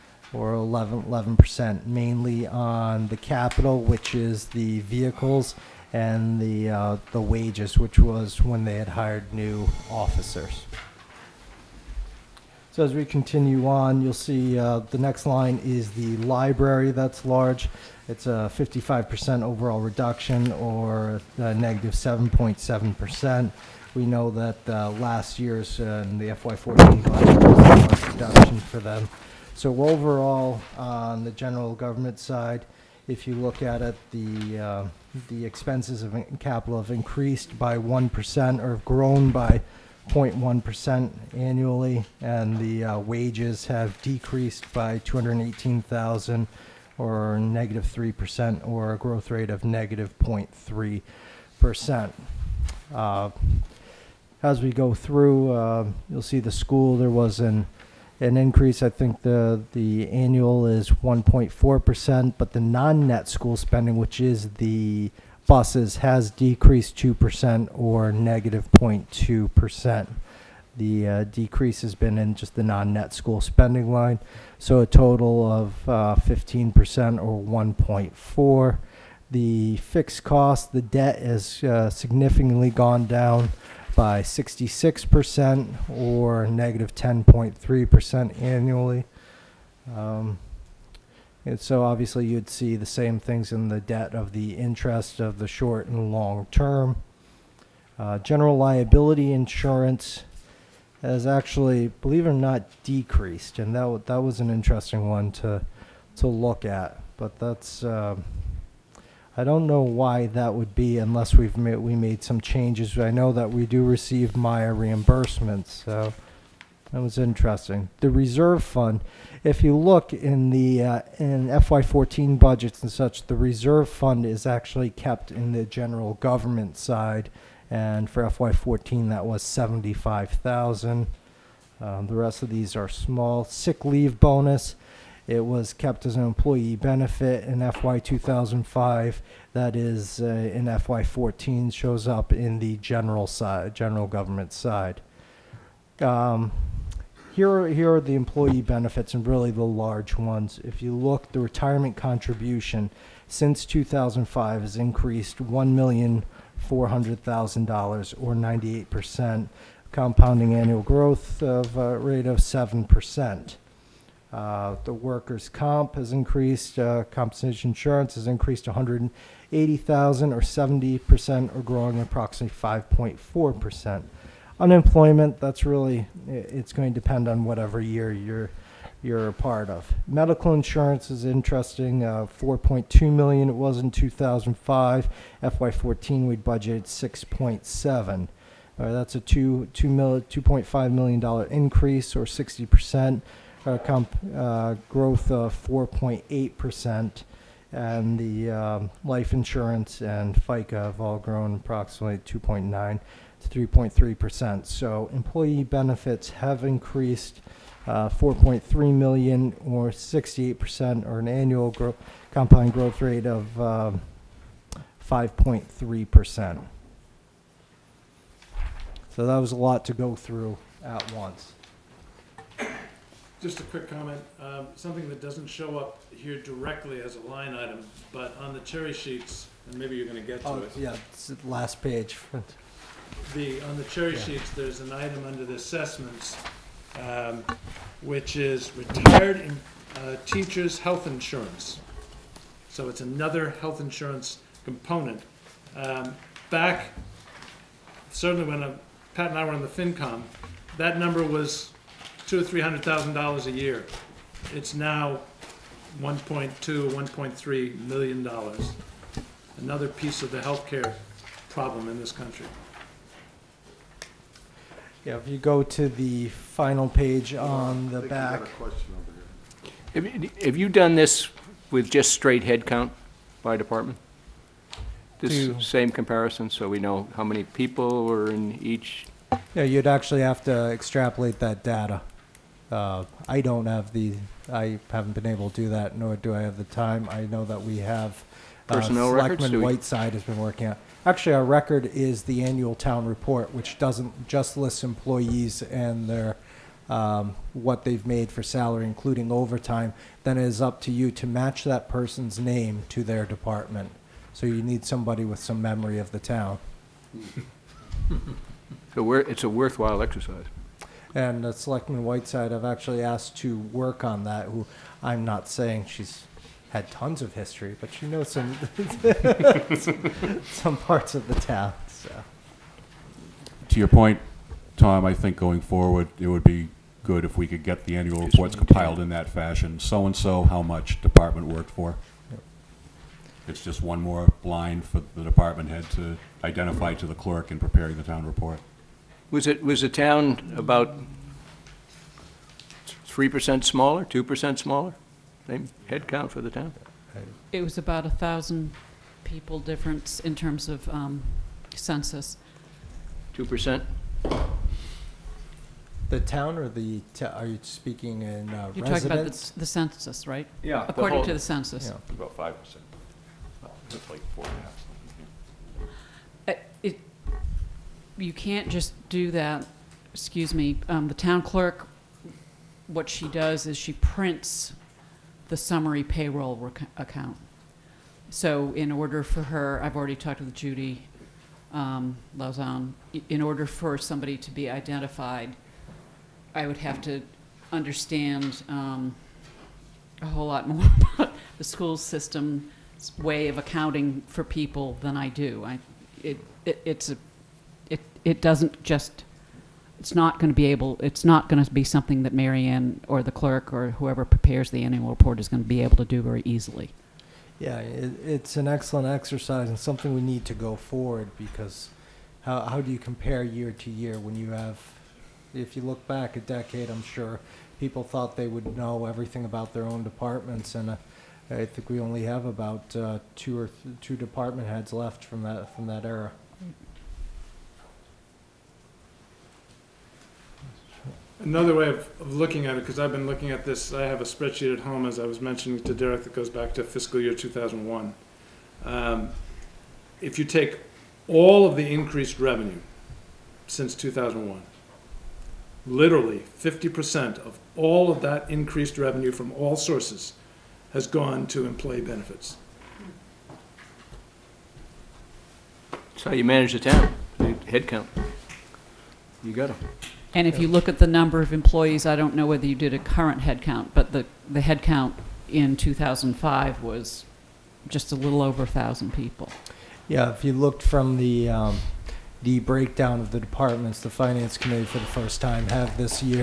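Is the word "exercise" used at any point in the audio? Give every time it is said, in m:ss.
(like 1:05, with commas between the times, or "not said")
5:10, 6:49.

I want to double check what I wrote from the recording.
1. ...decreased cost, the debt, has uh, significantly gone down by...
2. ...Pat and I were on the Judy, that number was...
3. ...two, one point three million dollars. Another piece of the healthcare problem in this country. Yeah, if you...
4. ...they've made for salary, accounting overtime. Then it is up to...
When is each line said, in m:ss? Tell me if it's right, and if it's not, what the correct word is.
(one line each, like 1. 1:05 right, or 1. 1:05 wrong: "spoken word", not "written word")
1. 1:19 wrong: "fixed", not "decreased"
2. 4:09 wrong: "FinCom", not "Judy"
3. 4:16 right
4. 4:57 wrong: "including", not "accounting".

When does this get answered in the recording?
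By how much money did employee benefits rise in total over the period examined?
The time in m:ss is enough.
3:28.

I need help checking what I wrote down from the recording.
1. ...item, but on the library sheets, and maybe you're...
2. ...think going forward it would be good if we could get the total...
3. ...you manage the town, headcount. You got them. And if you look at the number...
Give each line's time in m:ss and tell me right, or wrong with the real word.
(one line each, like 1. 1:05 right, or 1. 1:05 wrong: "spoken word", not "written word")
1. 3:47 wrong: "cherry", not "library"
2. 5:25 wrong: "annual", not "total"
3. 7:36 right.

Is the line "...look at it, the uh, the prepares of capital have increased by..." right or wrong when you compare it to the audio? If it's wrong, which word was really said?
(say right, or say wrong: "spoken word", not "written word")
wrong: "expenses", not "prepares".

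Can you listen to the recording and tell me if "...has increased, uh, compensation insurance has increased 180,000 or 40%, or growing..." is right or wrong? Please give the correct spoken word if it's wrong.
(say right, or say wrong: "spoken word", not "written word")
wrong: "70", not "40".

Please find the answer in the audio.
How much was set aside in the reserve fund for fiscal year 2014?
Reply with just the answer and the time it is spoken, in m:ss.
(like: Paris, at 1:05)
75,000, at 2:09.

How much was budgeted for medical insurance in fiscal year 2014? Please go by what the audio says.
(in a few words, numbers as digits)
6.7 million.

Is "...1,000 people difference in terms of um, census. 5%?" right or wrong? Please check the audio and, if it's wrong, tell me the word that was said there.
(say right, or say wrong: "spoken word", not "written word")
wrong: "2", not "5".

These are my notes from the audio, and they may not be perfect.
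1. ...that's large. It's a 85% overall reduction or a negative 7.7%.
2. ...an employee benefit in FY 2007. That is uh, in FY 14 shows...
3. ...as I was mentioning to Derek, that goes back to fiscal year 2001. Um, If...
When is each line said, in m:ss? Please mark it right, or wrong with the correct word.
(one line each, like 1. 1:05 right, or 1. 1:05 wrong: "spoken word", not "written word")
1. 0:16 wrong: "55", not "85"
2. 2:16 wrong: "2005", not "2007"
3. 7:15 right.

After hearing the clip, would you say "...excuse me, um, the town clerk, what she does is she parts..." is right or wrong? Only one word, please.
wrong.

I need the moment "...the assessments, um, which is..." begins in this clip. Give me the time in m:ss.
3:55.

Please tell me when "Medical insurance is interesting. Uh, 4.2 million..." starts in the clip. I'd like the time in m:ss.
3:00.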